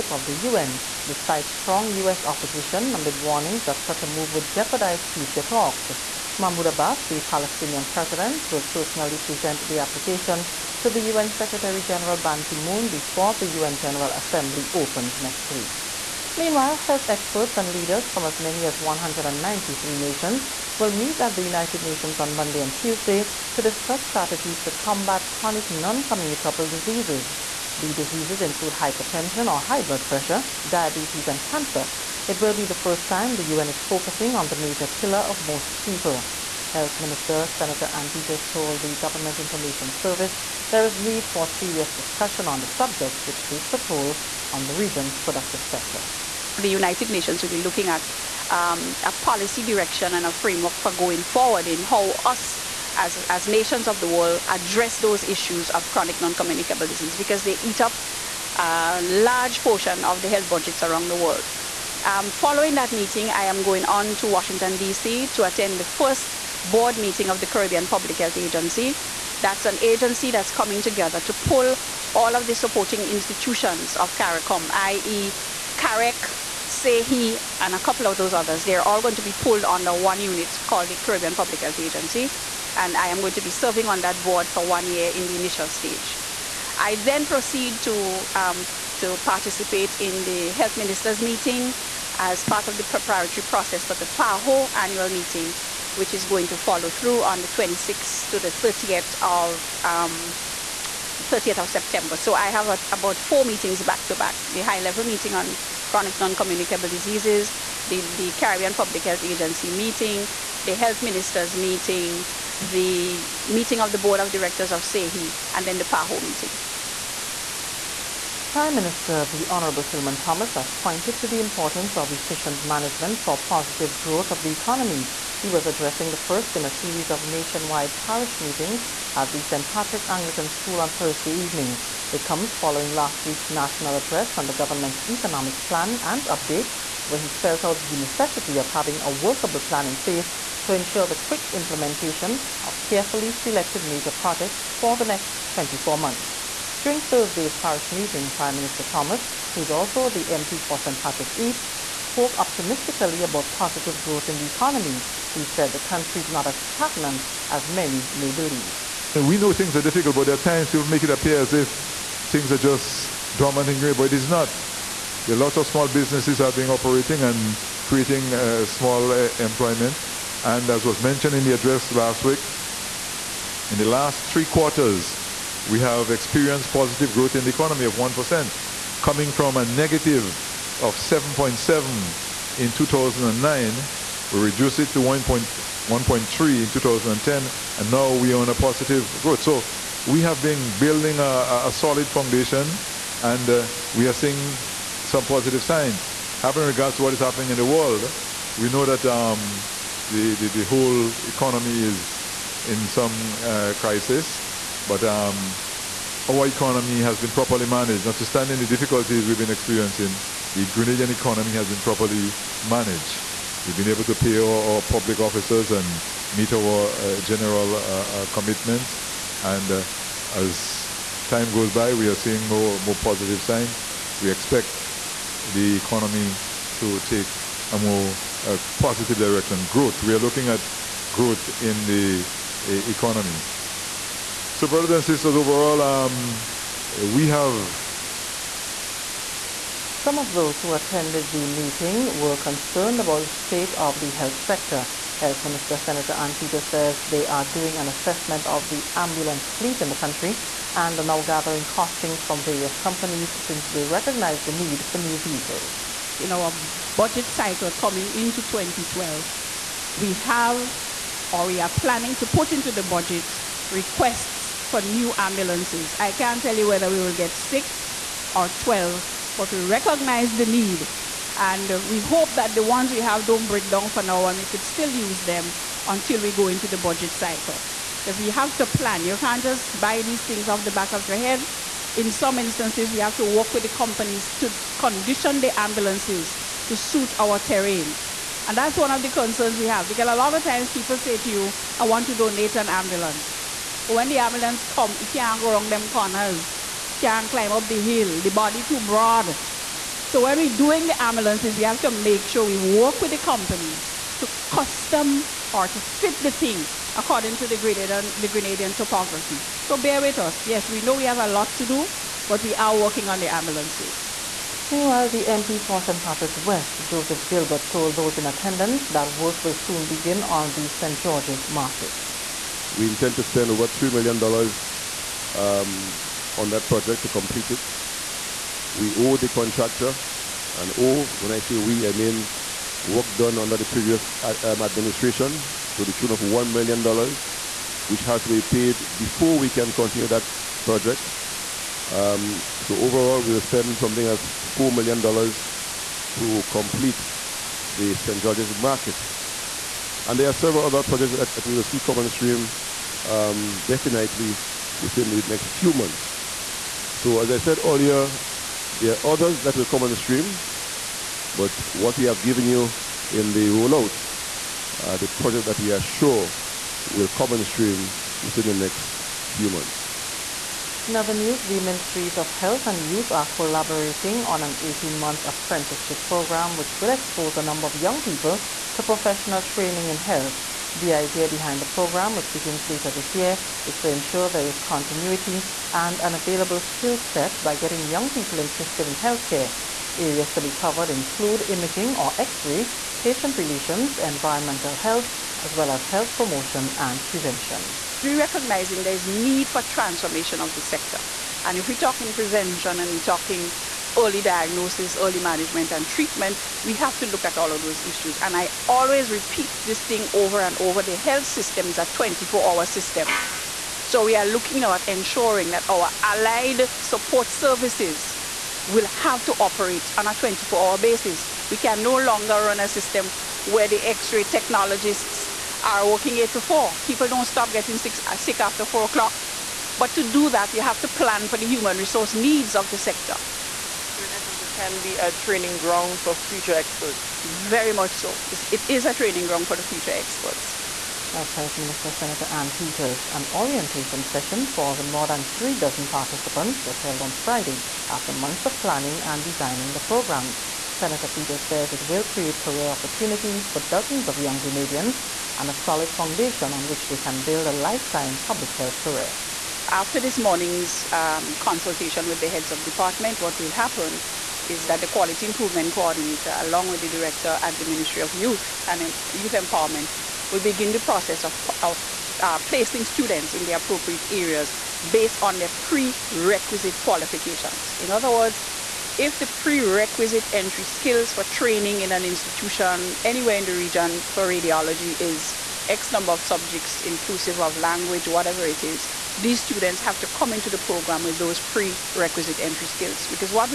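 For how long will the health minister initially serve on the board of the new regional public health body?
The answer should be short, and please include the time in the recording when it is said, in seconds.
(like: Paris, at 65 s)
1 year, at 84 s.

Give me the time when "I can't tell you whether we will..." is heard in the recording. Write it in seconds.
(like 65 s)
265 s.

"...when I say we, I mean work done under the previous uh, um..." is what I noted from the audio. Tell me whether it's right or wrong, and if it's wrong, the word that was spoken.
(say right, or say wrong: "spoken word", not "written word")
right.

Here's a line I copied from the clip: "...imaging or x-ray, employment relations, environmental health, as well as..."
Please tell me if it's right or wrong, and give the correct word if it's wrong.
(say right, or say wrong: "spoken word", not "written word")
wrong: "patient", not "employment".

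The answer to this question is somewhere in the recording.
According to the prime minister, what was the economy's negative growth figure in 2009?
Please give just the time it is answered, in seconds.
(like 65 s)
180 s.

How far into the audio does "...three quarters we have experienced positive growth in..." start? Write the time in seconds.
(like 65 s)
174 s.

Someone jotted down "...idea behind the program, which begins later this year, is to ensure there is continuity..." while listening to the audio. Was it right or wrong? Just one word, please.
right.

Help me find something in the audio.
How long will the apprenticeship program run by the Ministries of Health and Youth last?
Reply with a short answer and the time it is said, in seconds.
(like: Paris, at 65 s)
18 months, at 374 s.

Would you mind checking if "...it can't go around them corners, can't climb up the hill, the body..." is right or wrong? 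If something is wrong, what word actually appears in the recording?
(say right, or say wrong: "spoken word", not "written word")
right.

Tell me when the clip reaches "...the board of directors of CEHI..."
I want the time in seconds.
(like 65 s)
113 s.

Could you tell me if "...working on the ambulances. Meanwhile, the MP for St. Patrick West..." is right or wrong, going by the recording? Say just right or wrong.
right.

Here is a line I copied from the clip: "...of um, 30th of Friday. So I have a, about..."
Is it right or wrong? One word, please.
wrong.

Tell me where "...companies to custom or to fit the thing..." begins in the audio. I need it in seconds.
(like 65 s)
303 s.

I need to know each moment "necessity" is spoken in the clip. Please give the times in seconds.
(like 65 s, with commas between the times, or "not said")
137 s.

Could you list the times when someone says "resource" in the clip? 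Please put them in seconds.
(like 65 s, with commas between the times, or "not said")
431 s.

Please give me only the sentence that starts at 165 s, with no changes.
There are lots of small businesses are being operating and creating uh, small uh, employment.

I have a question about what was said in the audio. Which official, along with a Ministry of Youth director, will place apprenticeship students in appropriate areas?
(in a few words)
Quality Improvement Coordinator.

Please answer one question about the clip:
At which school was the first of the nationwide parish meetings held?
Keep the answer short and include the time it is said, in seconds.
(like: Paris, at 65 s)
St. Patrick Anglican School, at 129 s.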